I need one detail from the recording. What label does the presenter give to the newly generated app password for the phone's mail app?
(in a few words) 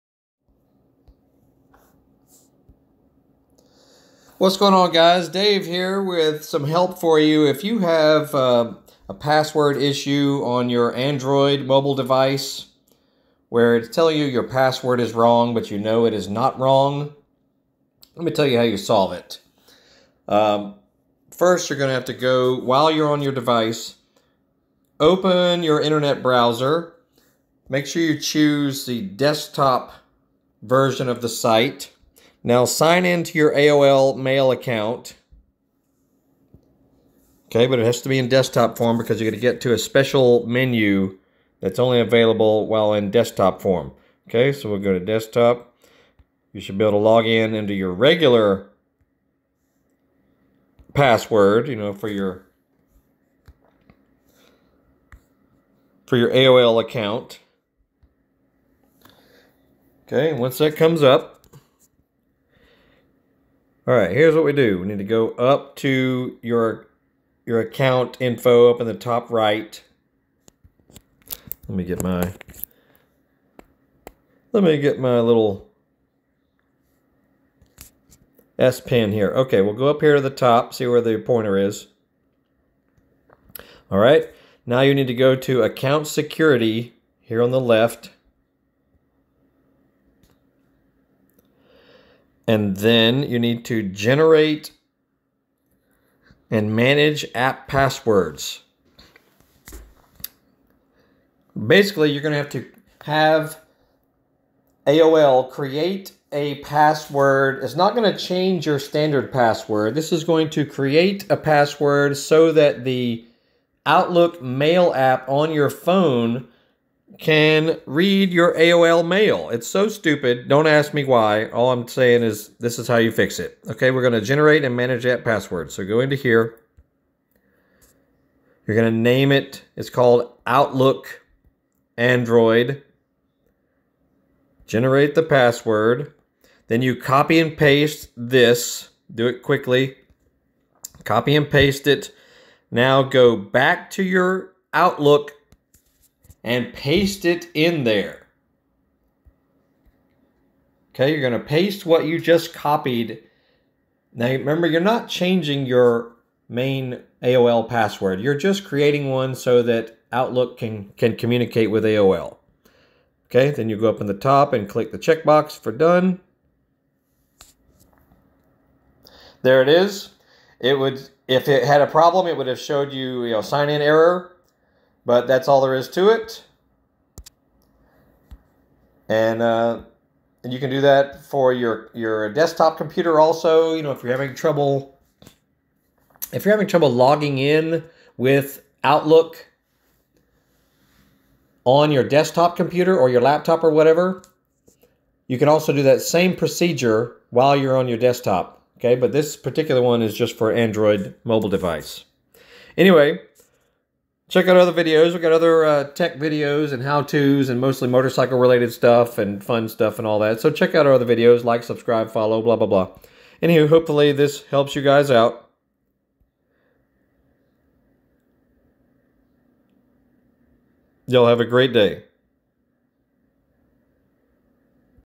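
Outlook Android.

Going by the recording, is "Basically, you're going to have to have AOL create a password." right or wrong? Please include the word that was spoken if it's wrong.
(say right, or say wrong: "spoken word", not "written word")
right.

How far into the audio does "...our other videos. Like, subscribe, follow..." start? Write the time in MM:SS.
03:30.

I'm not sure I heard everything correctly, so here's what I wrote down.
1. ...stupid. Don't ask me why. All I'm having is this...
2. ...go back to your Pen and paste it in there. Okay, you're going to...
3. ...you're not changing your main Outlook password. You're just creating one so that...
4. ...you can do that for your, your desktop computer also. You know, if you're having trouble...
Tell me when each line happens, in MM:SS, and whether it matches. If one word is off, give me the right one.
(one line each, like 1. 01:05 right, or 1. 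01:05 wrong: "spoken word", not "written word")
1. 01:59 wrong: "saying", not "having"
2. 02:23 wrong: "Outlook", not "Pen"
3. 02:34 wrong: "AOL", not "Outlook"
4. 03:00 right.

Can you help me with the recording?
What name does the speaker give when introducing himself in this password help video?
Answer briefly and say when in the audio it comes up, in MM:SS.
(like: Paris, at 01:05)
Dave, at 00:05.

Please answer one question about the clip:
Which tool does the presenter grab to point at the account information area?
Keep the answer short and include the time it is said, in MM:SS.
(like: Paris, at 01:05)
S Pen, at 01:18.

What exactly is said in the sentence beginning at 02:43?
Okay, then you go up in the top and click the checkbox for done.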